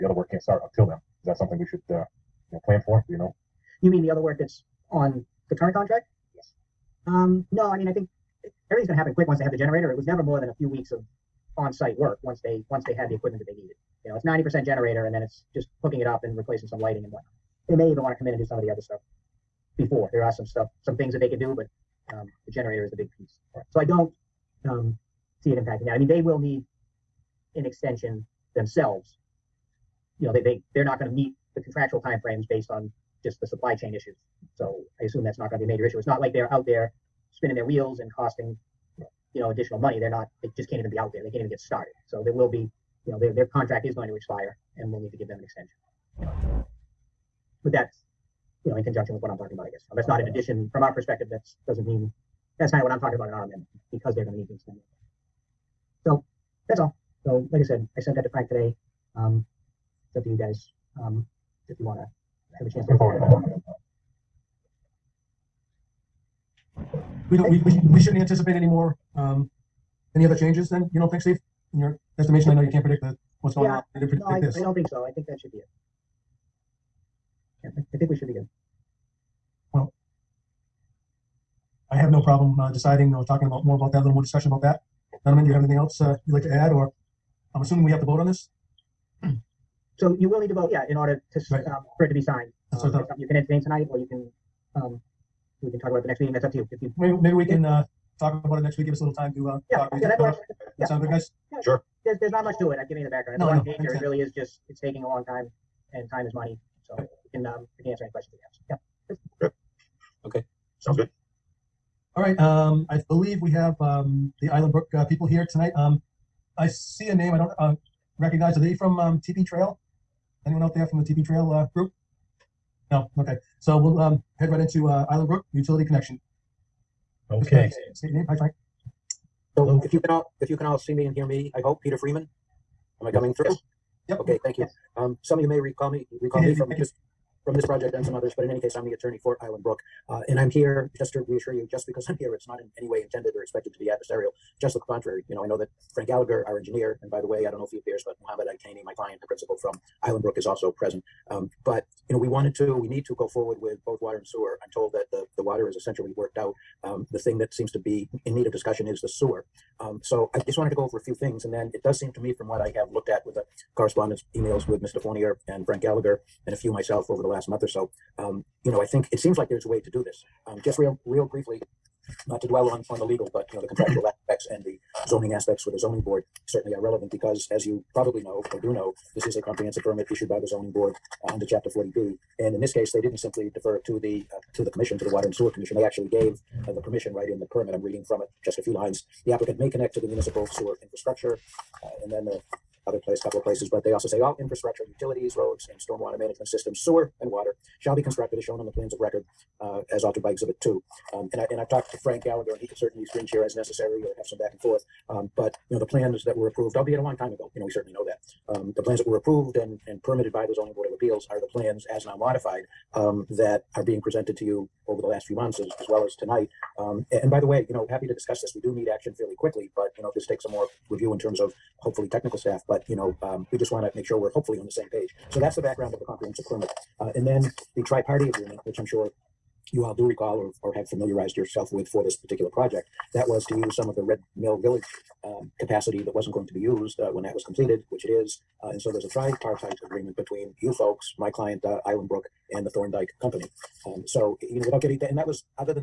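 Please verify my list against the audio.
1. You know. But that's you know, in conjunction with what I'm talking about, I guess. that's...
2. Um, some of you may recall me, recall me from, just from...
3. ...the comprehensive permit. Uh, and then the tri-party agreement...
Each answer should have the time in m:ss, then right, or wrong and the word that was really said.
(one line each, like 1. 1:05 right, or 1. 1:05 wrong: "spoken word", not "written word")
1. 0:46 right
2. 2:14 right
3. 3:45 right.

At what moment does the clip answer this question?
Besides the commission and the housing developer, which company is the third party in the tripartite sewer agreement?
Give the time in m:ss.
4:02.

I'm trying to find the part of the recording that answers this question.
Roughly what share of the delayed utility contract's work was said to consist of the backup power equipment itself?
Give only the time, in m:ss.
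0:14.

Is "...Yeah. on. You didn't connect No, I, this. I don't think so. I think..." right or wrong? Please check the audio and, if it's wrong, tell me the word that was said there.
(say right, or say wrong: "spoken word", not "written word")
wrong: "predict", not "connect".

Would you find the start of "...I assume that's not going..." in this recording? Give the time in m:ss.
0:35.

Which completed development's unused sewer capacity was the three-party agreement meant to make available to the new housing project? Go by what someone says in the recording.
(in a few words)
Red Mill Village.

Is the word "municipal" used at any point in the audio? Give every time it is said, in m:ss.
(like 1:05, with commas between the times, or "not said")
3:10.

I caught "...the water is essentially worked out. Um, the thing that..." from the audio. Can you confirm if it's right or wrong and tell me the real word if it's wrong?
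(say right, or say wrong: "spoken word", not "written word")
right.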